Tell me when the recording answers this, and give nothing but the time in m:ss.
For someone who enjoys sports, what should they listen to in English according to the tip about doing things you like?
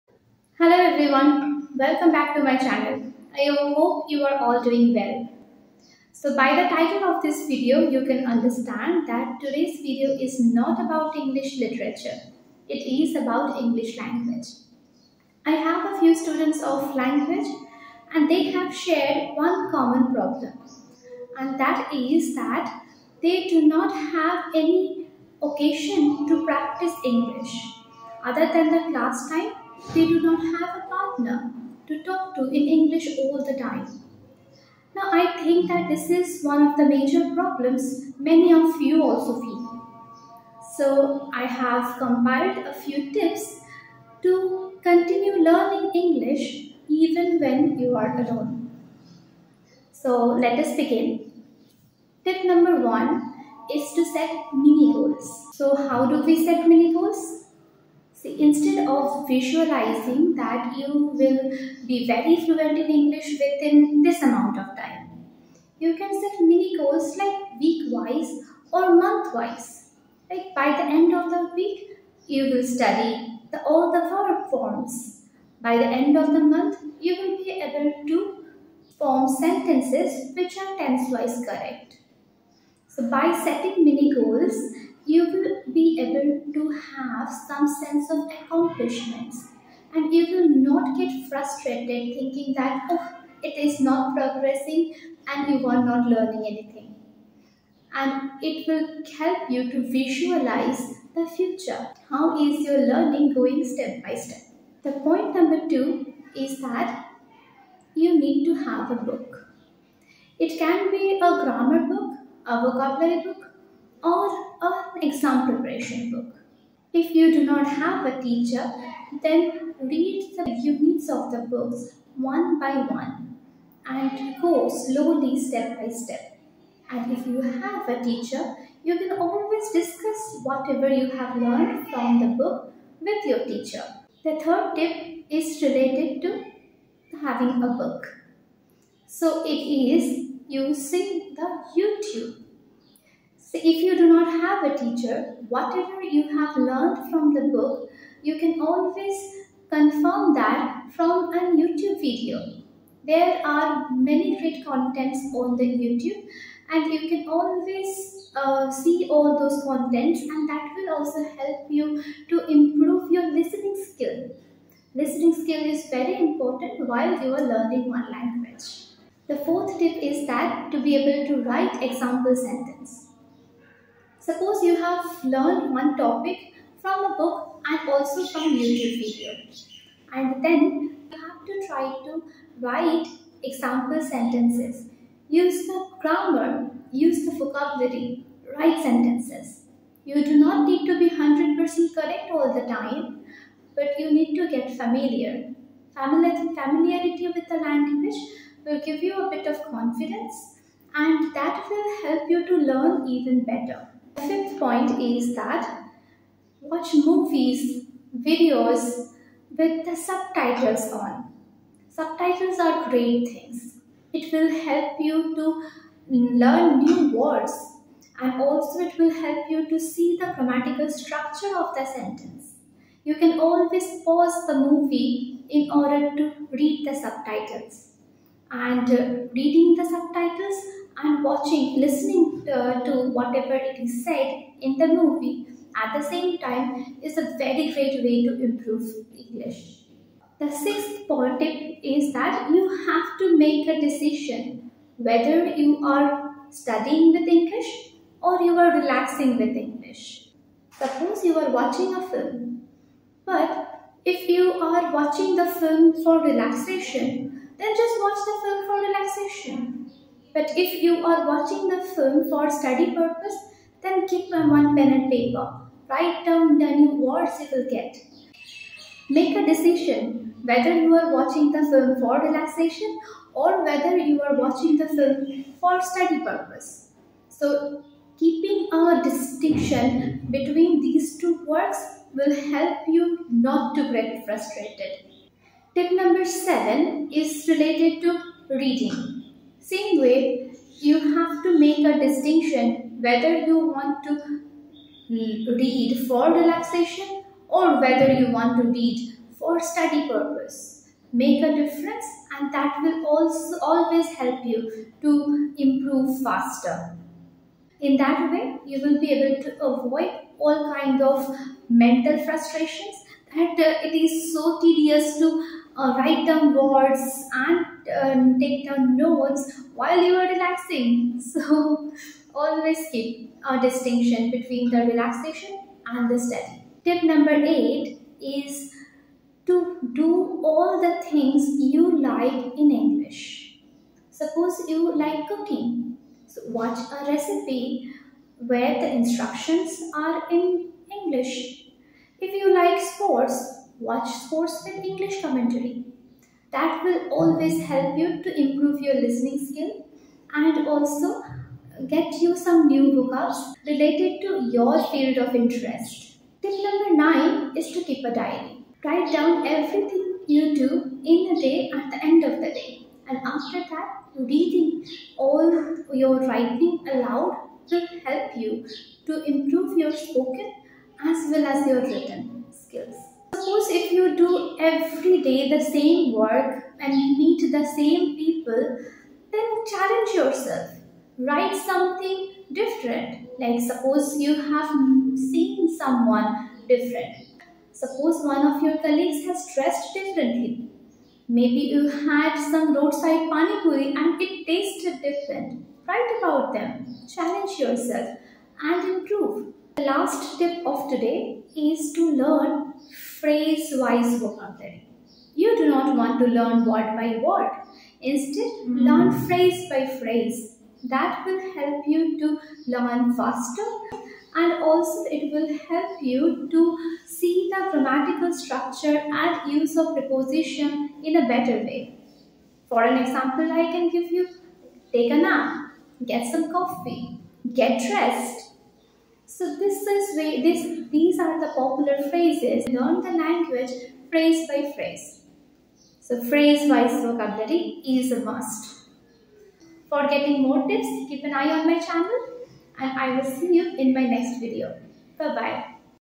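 5:44.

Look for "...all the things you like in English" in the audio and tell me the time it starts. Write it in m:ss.
5:30.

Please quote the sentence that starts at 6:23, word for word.
Like suppose you have seen someone different.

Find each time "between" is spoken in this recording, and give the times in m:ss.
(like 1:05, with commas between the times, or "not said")
4:40, 5:24.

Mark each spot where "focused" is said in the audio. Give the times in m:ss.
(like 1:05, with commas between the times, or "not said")
not said.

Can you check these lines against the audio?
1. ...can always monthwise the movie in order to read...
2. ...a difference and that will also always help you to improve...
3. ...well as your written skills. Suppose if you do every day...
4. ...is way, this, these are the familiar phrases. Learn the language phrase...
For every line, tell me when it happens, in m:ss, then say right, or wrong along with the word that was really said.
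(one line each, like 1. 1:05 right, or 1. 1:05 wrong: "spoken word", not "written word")
1. 3:43 wrong: "pause", not "monthwise"
2. 5:01 right
3. 6:11 right
4. 7:09 wrong: "popular", not "familiar".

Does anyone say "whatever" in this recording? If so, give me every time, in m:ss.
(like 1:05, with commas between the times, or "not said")
2:10, 2:25, 3:53.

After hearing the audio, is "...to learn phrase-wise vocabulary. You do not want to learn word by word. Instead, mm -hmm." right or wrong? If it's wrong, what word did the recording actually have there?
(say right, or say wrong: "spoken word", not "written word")
right.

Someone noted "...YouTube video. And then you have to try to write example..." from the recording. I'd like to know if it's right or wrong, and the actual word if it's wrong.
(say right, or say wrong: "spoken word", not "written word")
right.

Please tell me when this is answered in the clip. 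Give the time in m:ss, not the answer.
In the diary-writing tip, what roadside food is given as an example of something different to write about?
6:32.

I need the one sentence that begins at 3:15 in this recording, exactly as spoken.
Familiarity with the language will give you a bit of confidence and that will help you to learn even better.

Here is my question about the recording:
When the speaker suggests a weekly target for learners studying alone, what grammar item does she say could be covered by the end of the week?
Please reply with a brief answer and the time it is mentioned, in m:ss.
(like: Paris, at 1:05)
all the verb forms, at 1:13.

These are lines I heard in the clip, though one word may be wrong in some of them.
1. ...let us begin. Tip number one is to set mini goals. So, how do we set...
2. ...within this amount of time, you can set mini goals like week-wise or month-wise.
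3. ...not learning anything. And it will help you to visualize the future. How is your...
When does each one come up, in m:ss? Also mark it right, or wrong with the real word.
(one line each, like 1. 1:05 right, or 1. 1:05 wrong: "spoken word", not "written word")
1. 0:50 right
2. 1:03 right
3. 1:35 right.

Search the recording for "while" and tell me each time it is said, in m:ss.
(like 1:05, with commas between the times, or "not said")
2:46, 5:19.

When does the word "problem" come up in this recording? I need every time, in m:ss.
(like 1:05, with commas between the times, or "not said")
0:20, 0:37.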